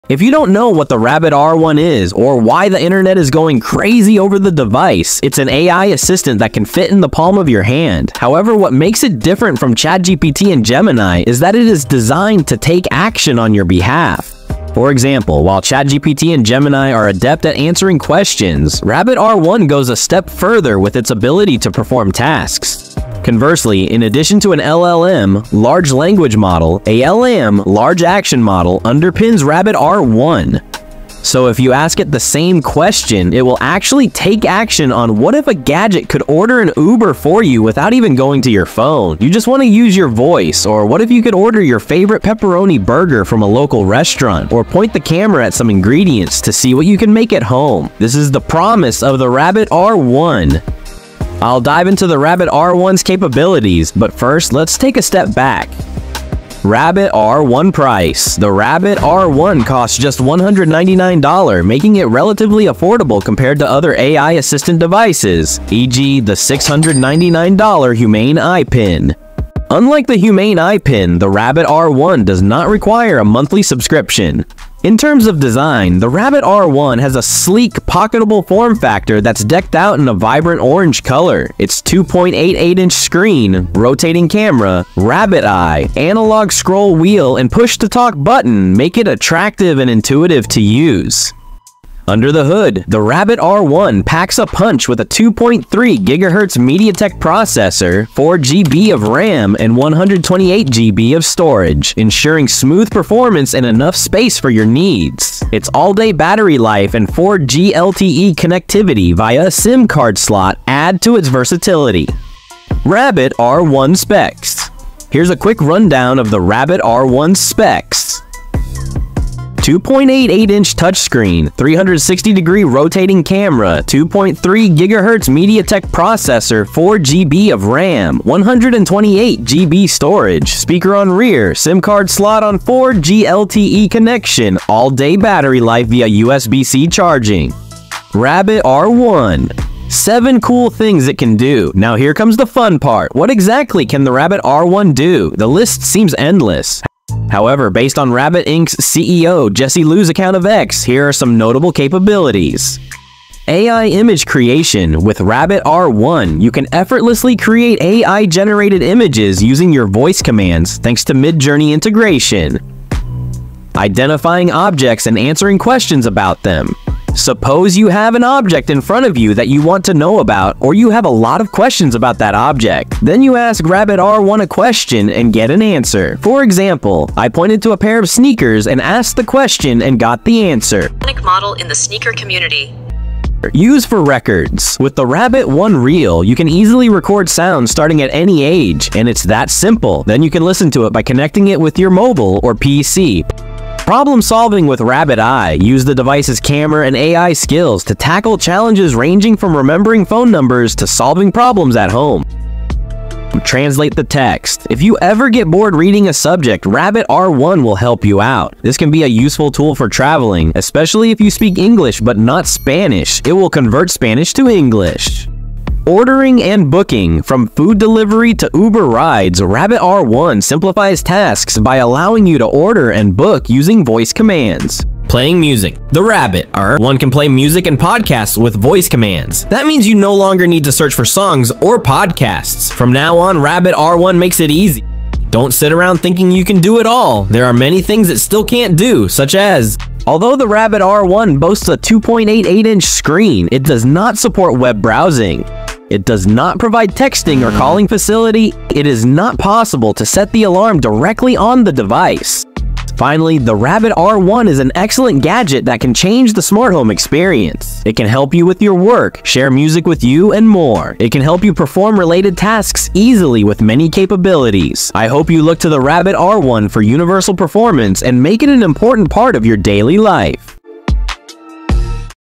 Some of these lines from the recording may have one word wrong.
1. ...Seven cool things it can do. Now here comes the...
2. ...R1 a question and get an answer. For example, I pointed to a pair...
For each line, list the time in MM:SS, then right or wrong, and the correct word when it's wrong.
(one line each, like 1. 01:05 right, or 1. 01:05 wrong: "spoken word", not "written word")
1. 02:19 right
2. 02:53 right.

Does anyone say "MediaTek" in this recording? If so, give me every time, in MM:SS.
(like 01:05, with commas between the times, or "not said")
01:36, 02:05.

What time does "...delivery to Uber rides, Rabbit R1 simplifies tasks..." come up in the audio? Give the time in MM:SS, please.
03:37.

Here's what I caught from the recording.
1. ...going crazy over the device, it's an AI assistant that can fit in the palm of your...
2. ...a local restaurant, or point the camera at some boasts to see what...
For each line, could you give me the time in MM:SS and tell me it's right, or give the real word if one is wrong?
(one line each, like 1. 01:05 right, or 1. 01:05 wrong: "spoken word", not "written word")
1. 00:03 right
2. 00:43 wrong: "ingredients", not "boasts".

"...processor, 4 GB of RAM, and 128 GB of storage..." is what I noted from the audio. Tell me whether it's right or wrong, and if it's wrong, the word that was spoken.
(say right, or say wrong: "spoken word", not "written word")
right.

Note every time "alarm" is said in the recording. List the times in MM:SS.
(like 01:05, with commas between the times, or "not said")
04:10.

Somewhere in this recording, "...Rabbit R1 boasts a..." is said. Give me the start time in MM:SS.
04:00.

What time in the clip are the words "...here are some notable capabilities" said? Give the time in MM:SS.
02:30.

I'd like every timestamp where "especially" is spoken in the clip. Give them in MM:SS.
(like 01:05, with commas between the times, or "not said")
03:30.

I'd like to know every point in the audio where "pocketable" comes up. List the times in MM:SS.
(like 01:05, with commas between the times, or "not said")
01:17.